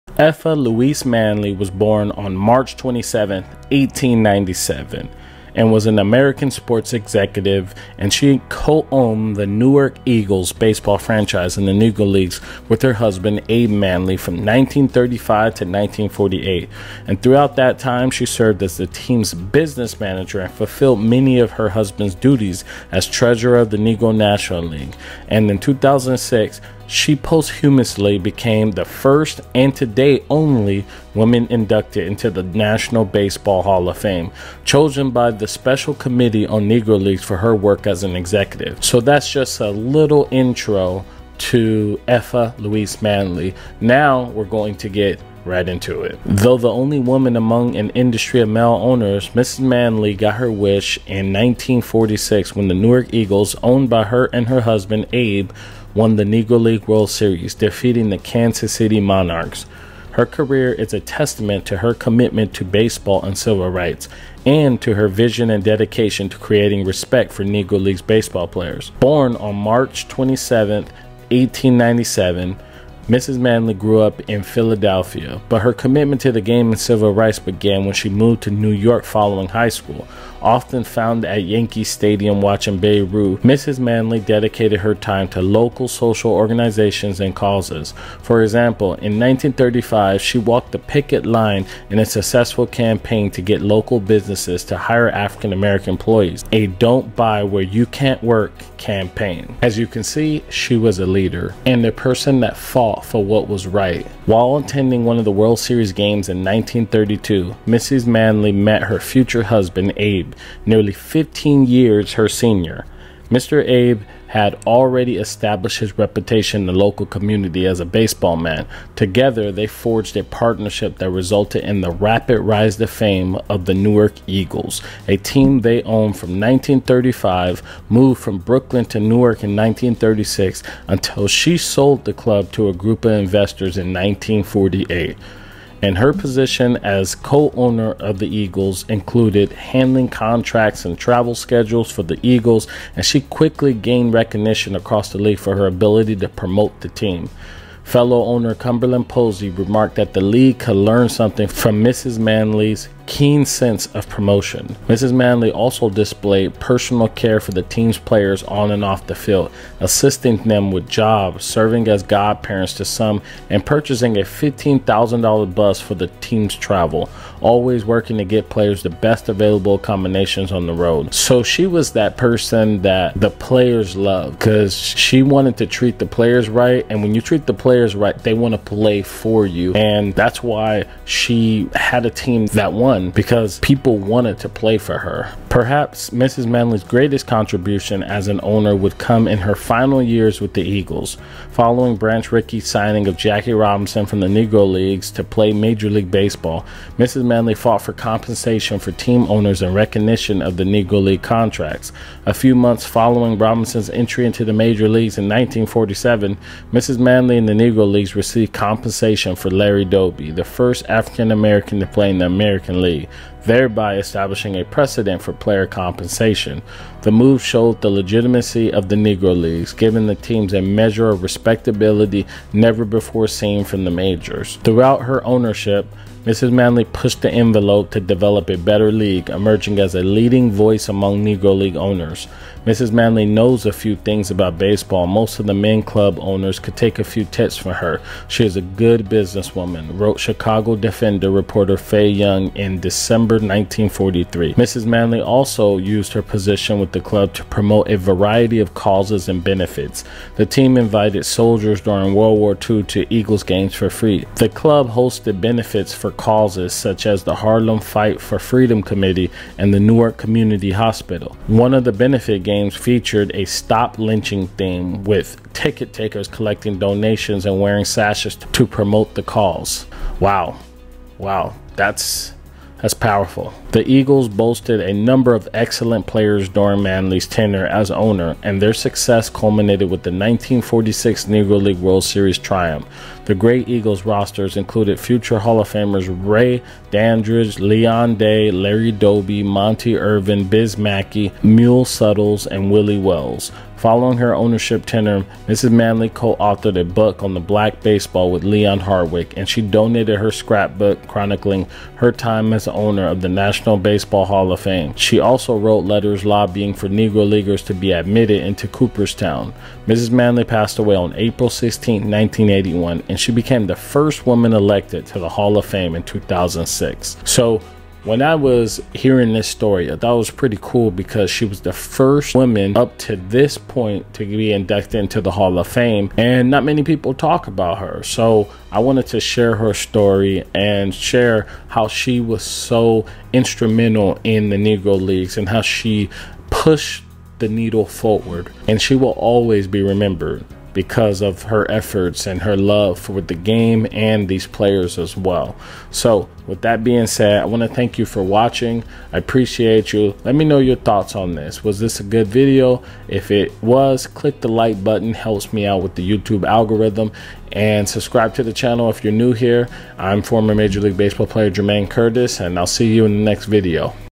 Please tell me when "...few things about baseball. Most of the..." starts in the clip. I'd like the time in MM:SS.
03:53.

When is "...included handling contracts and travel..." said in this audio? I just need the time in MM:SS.
02:18.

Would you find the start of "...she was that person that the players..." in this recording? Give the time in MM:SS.
02:51.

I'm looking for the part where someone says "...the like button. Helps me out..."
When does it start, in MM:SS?
05:54.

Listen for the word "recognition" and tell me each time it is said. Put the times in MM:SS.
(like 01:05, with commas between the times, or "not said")
02:24, 03:19.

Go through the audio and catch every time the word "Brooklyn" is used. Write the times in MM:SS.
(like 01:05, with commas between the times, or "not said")
02:08.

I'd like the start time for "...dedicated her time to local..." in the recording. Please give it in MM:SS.
01:24.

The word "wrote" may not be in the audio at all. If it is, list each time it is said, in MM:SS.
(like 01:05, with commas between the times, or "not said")
03:59, 05:05.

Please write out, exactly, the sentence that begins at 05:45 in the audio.
So with that being said, I want to thank you for watching.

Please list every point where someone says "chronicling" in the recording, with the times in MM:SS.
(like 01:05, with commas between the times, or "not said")
05:01.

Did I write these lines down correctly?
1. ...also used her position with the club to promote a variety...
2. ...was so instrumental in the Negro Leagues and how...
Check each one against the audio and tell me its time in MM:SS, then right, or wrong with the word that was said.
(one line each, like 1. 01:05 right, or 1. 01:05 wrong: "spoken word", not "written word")
1. 04:05 right
2. 05:32 right.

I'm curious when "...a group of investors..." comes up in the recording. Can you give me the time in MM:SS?
02:12.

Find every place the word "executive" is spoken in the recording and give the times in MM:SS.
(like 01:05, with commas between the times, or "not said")
00:06, 00:38.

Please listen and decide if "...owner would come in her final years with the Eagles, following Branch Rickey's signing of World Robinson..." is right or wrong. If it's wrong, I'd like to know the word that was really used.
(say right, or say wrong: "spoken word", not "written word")
wrong: "Jackie", not "World".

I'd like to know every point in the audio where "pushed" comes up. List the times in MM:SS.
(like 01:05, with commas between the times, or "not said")
03:46, 05:36.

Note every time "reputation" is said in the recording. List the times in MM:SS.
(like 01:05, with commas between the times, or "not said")
01:55.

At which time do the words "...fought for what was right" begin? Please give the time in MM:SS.
01:42.